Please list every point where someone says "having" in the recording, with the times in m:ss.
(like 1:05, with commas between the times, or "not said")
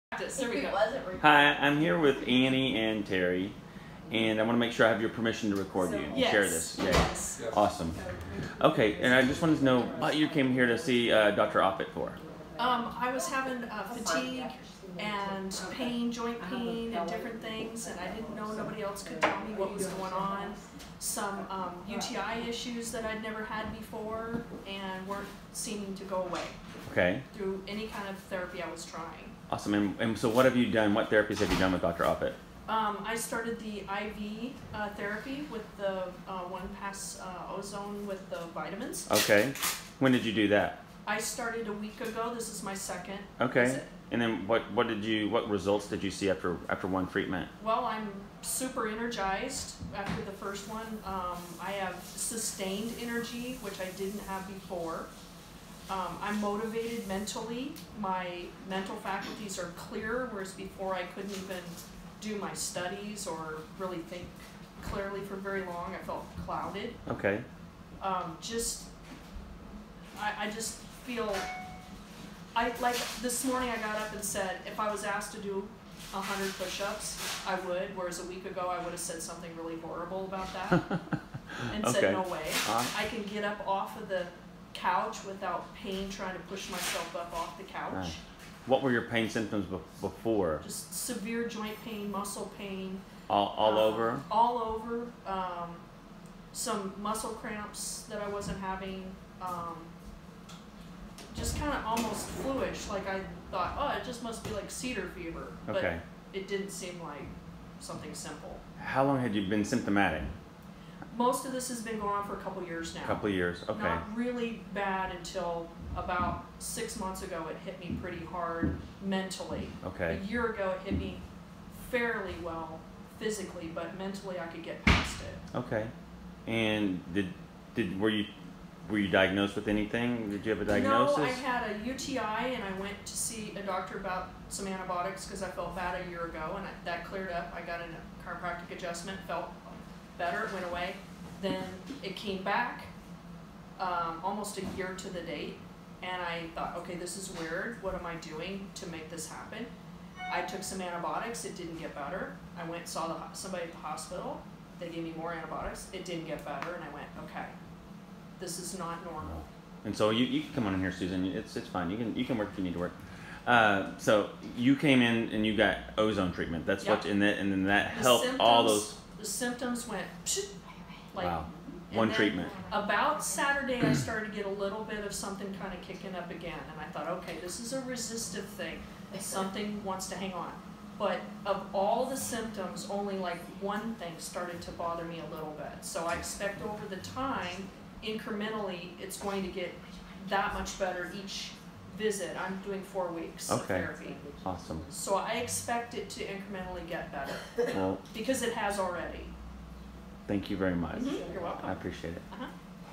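0:13, 1:38.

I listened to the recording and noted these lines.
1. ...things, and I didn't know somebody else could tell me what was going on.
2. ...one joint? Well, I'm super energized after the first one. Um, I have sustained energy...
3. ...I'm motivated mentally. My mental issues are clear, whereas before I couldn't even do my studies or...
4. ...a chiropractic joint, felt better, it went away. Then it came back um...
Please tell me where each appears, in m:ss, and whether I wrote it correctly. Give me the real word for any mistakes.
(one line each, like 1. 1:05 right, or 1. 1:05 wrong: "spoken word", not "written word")
1. 0:17 wrong: "nobody", not "somebody"
2. 0:46 wrong: "treatment", not "joint"
3. 0:56 wrong: "faculties", not "issues"
4. 2:17 wrong: "adjustment", not "joint".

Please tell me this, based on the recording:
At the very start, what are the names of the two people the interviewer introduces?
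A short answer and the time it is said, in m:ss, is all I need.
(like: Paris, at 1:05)
Annie and Terry, at 0:02.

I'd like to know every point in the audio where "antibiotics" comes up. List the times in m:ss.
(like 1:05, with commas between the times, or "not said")
2:14, 2:30, 2:35.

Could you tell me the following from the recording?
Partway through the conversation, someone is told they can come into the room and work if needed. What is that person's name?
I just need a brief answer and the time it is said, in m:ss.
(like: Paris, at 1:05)
Susan, at 2:40.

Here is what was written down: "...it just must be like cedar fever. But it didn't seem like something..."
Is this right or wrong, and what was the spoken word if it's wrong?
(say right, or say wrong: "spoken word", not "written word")
right.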